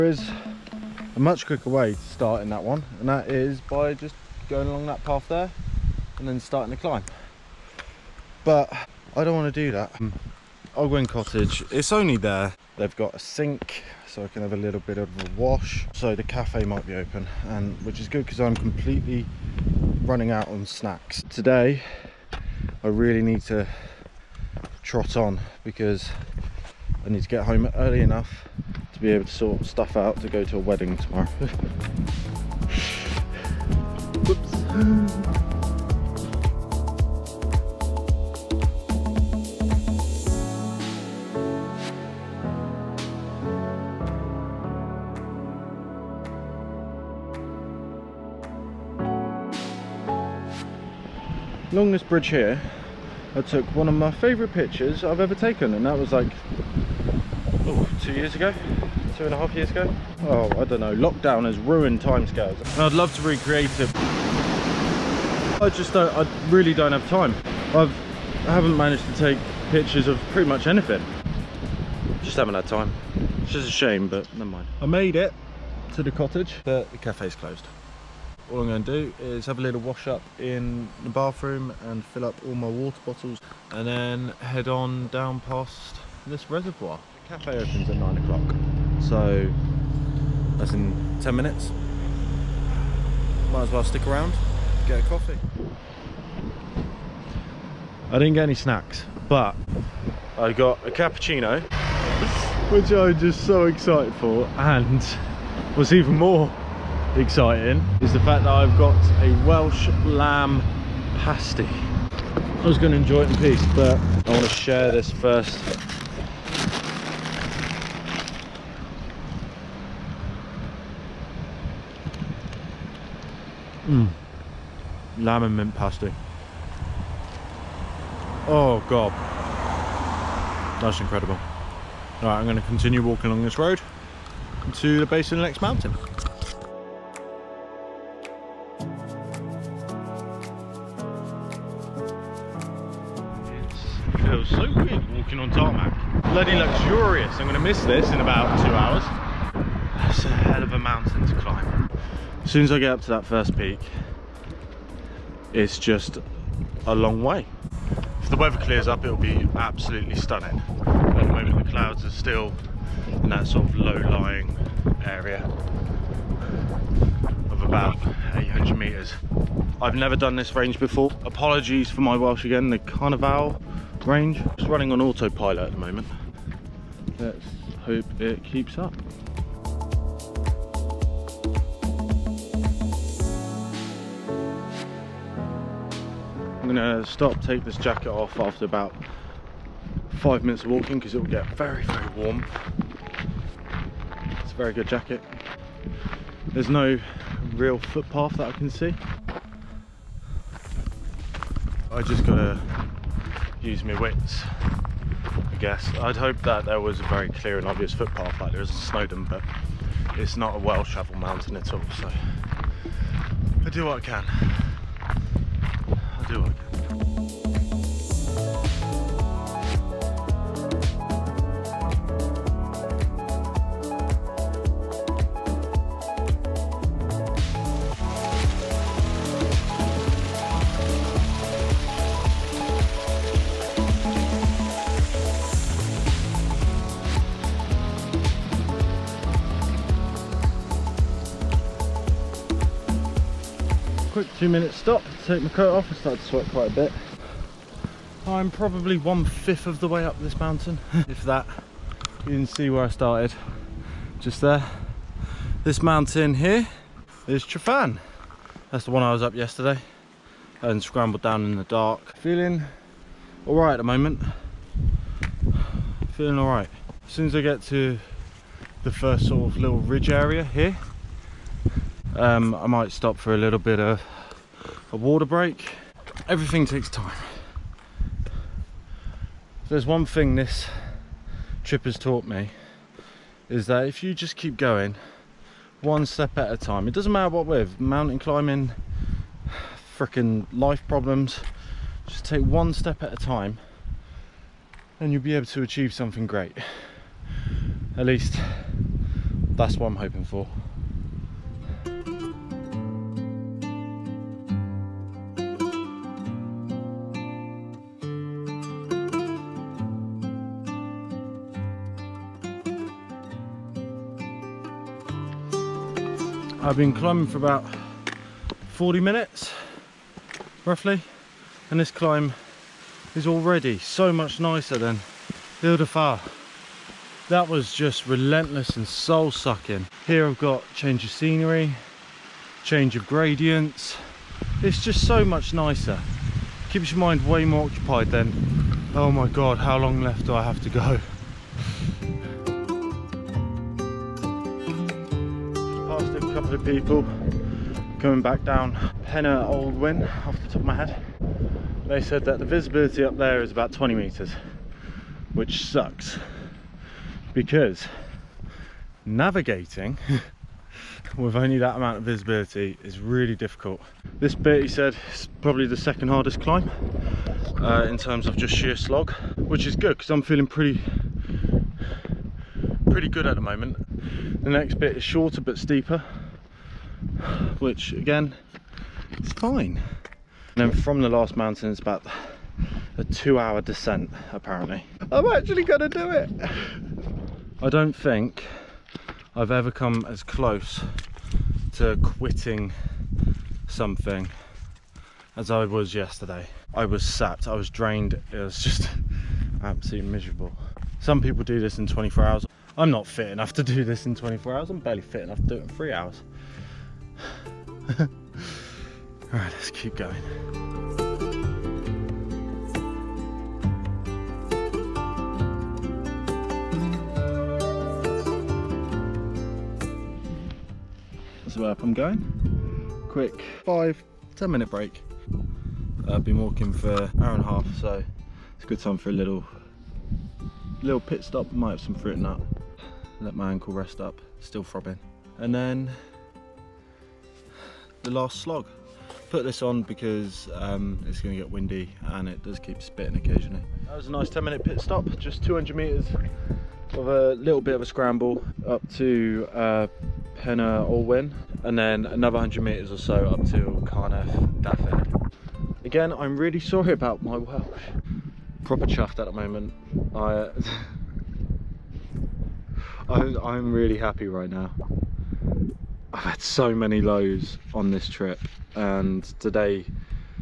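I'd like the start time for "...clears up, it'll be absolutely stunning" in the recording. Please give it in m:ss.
2:38.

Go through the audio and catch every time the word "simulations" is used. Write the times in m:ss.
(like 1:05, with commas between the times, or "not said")
not said.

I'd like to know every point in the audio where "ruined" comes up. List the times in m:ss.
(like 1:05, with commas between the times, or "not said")
1:01.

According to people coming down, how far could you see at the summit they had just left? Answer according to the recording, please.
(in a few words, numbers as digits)
20 meters.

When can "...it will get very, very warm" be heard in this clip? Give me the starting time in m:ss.
3:11.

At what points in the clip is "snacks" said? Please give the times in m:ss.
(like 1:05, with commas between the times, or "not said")
0:20, 1:38.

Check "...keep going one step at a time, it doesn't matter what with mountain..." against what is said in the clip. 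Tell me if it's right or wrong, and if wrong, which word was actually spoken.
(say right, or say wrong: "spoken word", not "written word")
right.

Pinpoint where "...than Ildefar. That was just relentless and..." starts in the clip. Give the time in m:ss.
5:24.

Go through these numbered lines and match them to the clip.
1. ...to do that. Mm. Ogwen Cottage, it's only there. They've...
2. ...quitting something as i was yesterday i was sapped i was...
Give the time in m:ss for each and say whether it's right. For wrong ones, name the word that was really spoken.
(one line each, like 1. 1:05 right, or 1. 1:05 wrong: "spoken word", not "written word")
1. 0:09 right
2. 6:32 right.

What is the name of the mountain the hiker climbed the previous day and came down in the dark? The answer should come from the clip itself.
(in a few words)
Tryfan.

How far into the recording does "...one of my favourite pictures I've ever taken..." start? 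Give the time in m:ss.
0:53.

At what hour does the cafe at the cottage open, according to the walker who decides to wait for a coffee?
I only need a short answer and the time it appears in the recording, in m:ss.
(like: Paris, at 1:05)
9 o'clock, at 1:27.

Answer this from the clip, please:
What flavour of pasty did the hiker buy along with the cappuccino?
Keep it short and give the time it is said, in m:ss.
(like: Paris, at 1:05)
Lamb and mint, at 2:05.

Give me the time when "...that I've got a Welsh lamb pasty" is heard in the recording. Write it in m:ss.
1:48.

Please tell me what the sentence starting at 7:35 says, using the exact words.
Again, I'm really sorry about my Welsh.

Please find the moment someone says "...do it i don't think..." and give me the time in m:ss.
6:25.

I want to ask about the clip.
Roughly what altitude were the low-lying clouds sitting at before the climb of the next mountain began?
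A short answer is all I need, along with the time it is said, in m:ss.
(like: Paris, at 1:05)
800 meters, at 2:48.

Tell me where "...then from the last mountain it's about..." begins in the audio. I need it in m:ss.
6:20.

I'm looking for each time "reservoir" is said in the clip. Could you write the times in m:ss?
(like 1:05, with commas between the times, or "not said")
1:26.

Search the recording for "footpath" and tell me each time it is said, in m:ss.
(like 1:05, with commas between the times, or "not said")
3:17, 3:27.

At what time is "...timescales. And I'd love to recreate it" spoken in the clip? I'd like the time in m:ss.
1:02.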